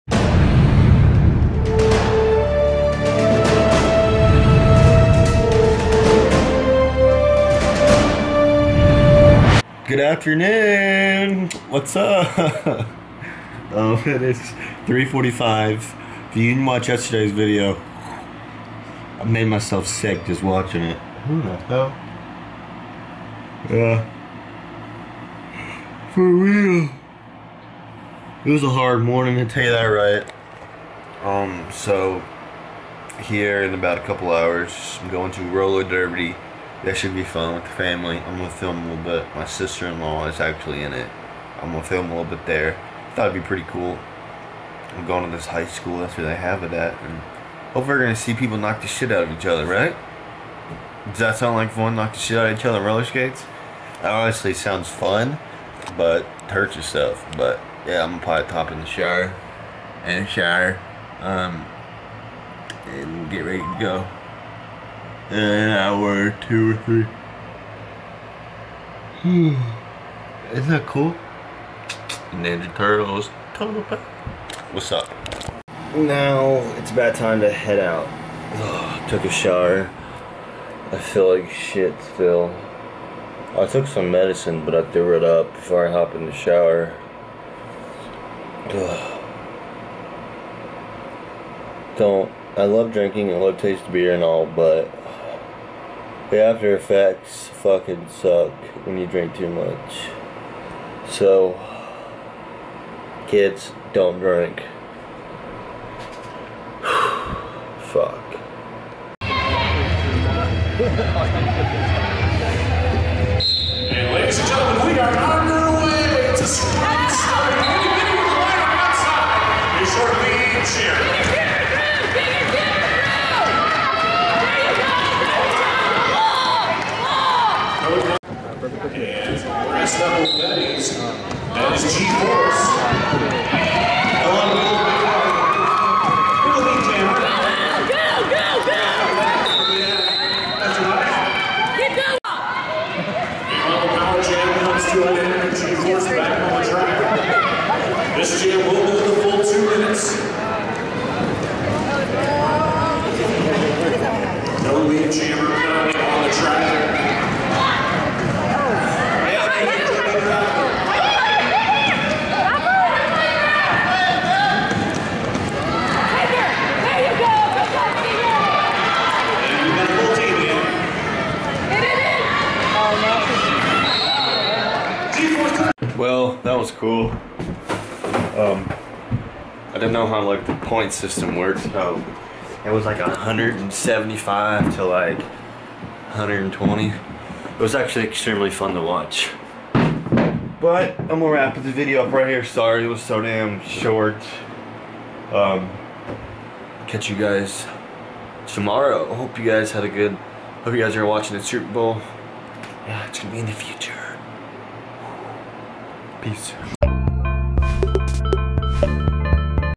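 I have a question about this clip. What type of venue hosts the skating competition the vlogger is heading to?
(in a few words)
High school.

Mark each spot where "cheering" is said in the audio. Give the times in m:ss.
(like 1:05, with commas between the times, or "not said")
2:01.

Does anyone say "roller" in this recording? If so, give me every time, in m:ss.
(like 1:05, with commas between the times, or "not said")
0:35, 0:52.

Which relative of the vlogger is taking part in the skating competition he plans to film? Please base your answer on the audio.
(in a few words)
Sister-in-law.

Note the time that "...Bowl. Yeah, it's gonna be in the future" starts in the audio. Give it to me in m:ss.
3:21.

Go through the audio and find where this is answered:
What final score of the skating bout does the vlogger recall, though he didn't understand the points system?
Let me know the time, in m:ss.
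3:02.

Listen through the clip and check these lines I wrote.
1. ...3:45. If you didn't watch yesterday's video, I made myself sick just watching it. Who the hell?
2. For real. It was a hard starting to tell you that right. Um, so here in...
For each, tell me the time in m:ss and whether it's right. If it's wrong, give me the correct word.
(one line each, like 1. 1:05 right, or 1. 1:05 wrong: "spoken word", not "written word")
1. 0:14 right
2. 0:26 wrong: "morning", not "starting".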